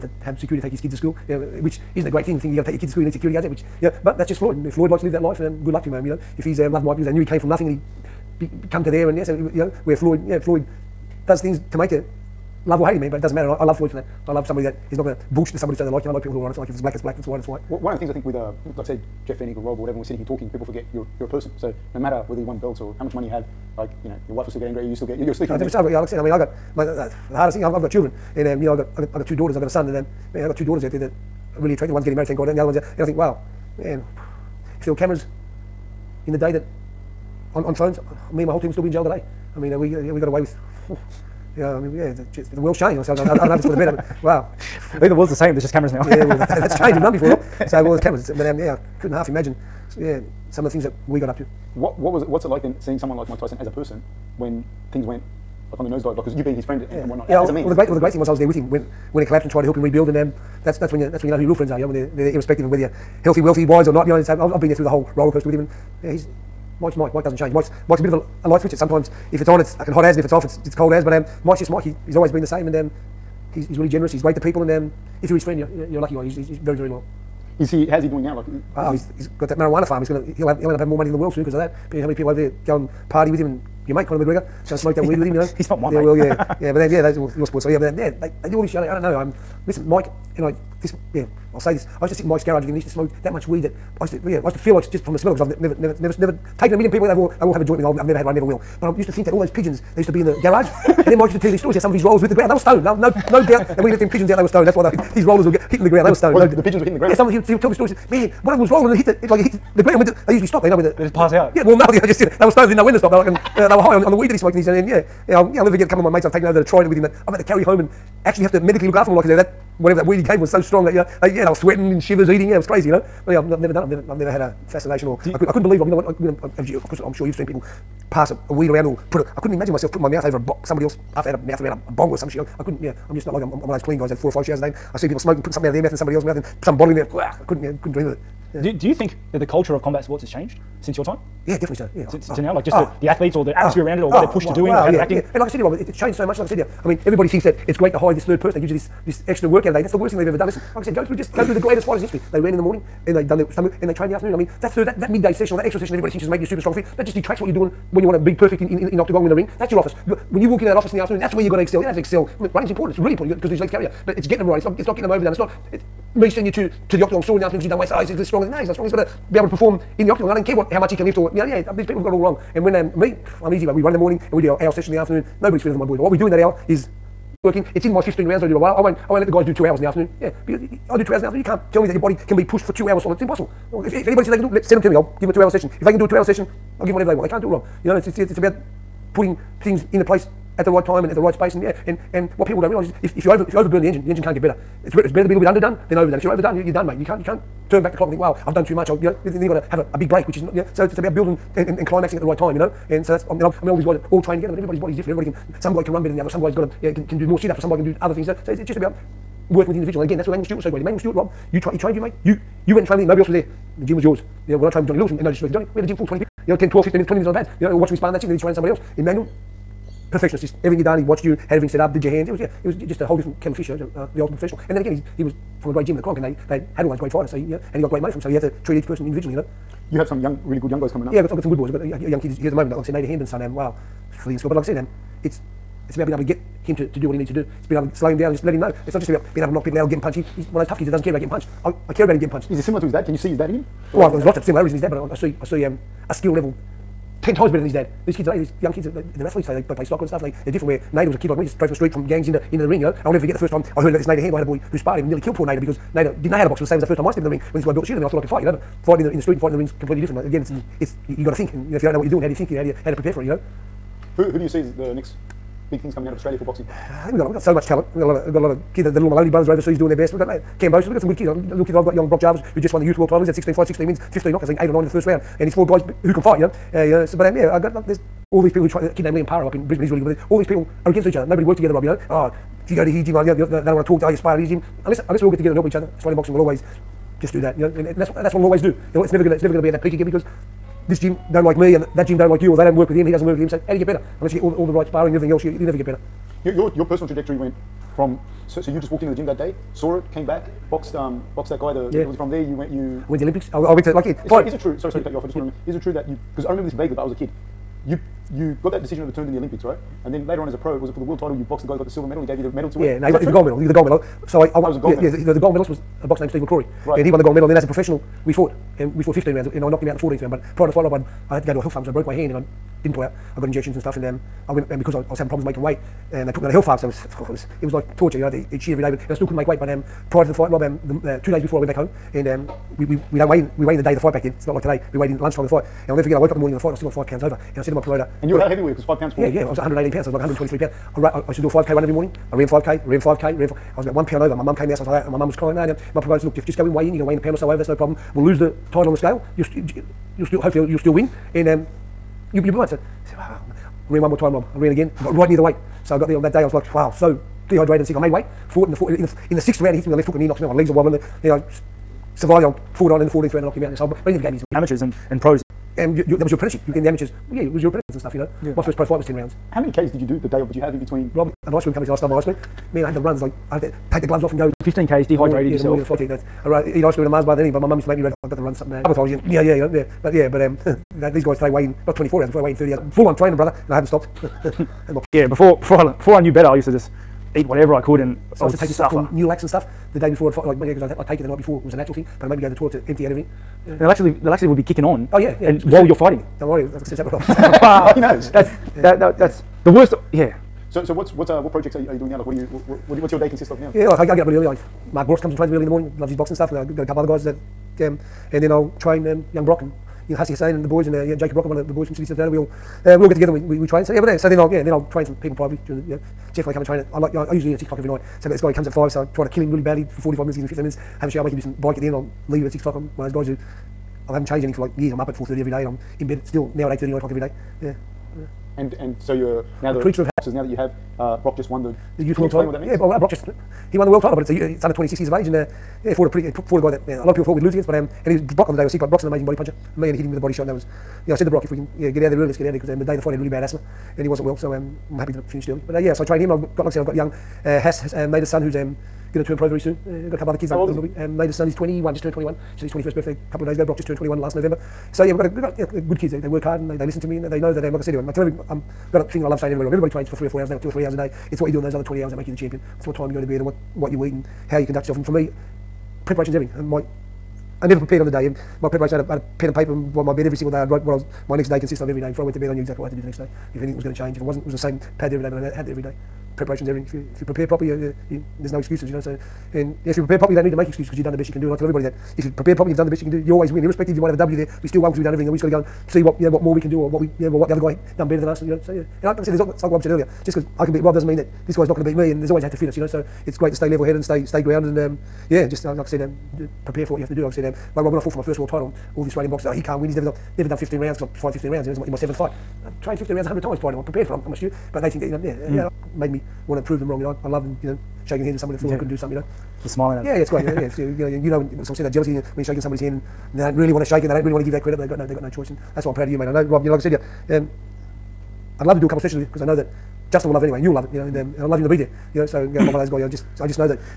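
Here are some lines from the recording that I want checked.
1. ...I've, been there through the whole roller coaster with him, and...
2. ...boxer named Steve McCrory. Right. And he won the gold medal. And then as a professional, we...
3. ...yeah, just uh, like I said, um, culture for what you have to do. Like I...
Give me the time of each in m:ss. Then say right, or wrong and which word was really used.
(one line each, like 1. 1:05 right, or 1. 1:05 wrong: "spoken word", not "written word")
1. 1:04 right
2. 5:16 right
3. 8:15 wrong: "prepare", not "culture".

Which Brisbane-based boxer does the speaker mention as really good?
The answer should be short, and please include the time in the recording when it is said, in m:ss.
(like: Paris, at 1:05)
Liam Paro, at 4:39.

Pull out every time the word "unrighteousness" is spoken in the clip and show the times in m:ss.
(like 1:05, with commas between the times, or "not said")
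not said.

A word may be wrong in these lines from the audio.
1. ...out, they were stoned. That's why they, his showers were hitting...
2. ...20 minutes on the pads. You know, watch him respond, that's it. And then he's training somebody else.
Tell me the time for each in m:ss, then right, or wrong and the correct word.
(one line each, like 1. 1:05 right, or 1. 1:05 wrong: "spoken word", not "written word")
1. 1:44 wrong: "rollers", not "showers"
2. 3:37 right.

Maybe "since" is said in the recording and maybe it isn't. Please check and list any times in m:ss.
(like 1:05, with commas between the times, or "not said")
2:20, 6:36.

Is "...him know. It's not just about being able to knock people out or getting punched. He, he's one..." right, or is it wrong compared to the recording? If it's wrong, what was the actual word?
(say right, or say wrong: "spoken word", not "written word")
right.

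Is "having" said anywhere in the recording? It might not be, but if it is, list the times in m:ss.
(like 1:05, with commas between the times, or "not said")
1:20, 5:25.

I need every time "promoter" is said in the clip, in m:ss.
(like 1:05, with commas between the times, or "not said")
5:37, 5:45.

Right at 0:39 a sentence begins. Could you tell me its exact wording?
I mean, uh, we uh, yeah, we got away with.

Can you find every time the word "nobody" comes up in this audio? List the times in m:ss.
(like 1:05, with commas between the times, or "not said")
2:55, 3:33, 4:41.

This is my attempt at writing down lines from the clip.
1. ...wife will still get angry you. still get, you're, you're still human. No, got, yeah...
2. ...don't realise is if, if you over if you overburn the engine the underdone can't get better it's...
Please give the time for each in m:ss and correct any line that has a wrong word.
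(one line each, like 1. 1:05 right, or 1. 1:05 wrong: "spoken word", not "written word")
1. 0:24 right
2. 3:12 wrong: "engine", not "underdone".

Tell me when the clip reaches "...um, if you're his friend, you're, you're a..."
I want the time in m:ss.
1:14.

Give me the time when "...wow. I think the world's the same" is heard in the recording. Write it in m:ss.
0:44.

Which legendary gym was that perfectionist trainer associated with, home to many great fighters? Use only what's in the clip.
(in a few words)
The Kronk.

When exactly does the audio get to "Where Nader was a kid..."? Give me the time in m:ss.
4:10.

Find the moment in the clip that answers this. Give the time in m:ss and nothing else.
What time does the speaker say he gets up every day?
7:05.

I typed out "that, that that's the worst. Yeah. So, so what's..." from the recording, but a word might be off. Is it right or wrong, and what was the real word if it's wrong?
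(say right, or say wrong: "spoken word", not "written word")
right.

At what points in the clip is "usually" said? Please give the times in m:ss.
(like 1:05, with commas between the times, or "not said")
1:50, 6:57.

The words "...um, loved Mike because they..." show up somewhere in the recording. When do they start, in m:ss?
0:06.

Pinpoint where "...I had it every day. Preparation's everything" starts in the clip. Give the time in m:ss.
7:55.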